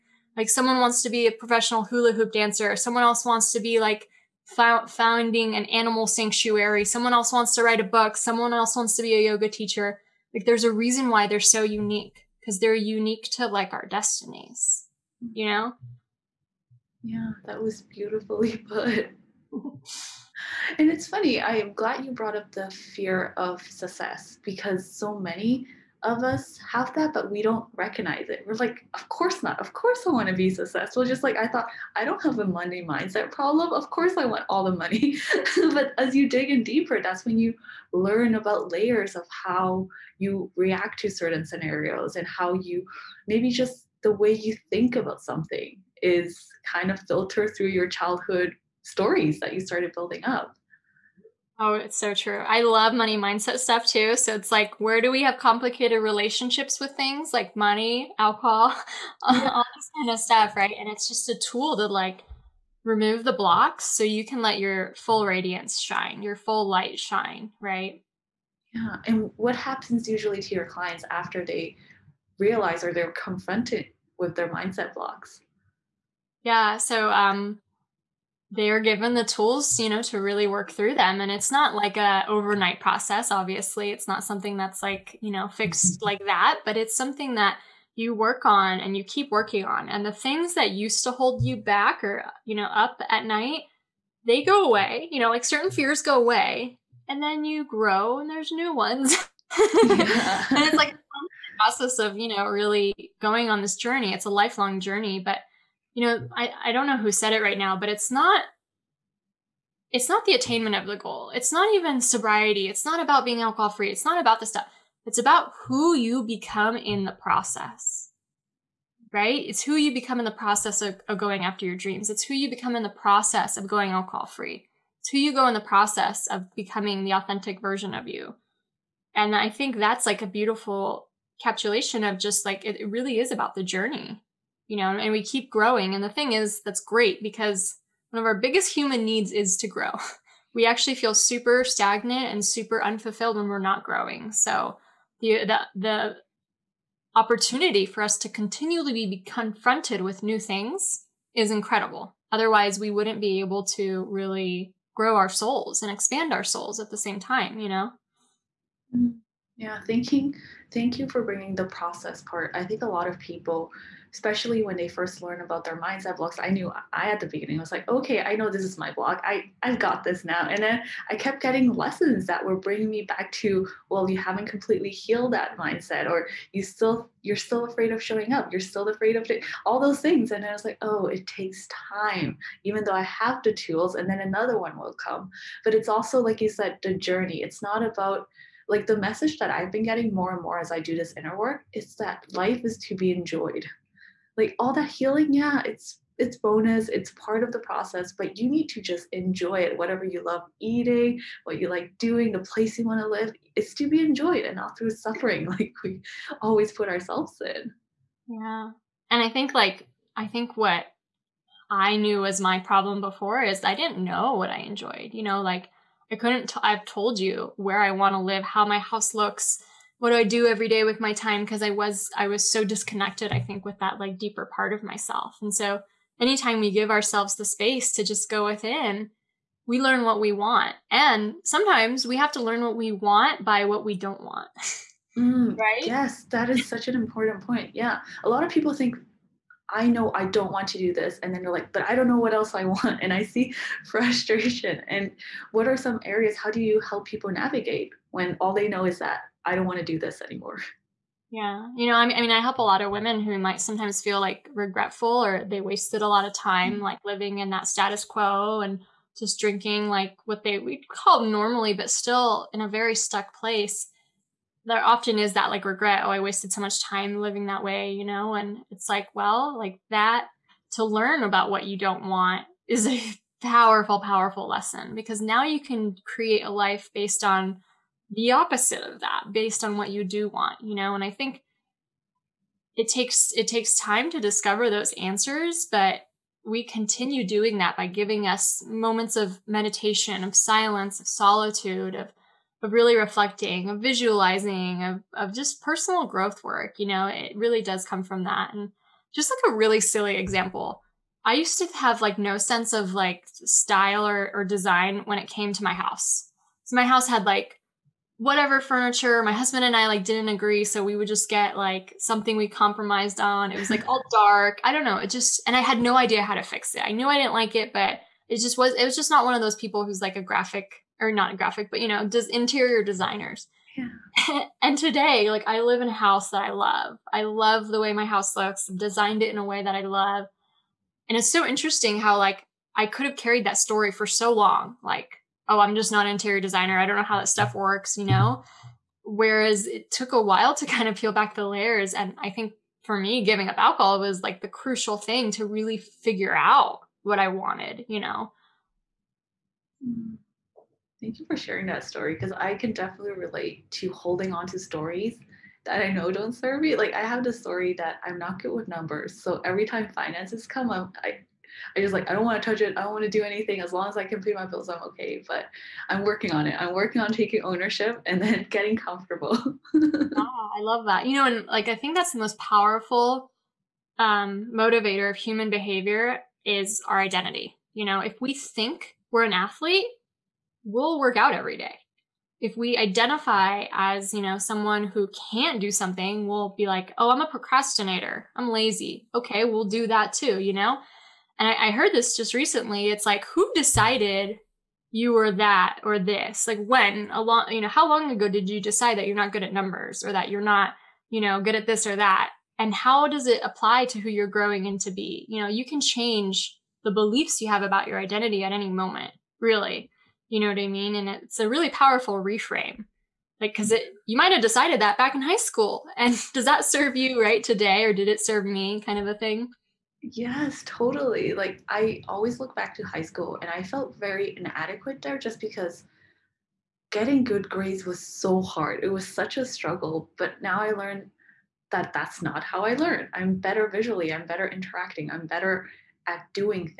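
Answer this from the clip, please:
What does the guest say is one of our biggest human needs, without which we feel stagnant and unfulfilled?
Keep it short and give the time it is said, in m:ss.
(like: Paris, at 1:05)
to grow, at 2:19.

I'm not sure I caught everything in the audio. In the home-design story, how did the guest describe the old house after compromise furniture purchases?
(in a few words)
dark.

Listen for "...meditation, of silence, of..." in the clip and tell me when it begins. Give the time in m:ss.
4:49.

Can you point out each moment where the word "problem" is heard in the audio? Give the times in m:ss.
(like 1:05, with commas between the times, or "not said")
0:33, 3:32.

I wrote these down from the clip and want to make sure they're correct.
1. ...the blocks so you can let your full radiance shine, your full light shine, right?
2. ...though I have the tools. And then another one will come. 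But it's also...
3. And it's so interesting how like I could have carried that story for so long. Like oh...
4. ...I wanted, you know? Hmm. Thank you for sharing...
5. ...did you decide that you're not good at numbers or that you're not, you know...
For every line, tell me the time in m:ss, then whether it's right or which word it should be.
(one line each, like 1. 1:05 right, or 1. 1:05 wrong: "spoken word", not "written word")
1. 1:03 right
2. 3:02 right
3. 5:31 right
4. 5:47 right
5. 6:38 right.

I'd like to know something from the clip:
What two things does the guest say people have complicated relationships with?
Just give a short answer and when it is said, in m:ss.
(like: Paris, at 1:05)
money, alcohol, at 0:57.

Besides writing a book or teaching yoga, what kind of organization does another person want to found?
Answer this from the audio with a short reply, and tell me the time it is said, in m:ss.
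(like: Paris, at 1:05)
animal sanctuary, at 0:05.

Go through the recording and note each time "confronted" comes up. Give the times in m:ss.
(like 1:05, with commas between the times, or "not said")
1:13, 2:29.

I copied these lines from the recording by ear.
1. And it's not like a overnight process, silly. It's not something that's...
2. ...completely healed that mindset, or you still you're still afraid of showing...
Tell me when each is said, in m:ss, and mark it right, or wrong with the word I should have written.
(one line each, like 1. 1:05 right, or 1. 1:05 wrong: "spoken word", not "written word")
1. 1:21 wrong: "obviously", not "silly"
2. 2:54 right.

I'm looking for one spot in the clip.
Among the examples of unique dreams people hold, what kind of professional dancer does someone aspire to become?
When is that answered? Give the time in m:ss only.
0:01.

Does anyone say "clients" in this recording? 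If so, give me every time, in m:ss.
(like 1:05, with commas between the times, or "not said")
1:10.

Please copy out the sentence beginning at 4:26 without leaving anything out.
Oh, I wasted so much time living that way, you know?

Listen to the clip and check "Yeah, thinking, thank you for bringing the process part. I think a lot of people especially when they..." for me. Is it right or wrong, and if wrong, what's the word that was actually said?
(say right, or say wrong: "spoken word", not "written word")
right.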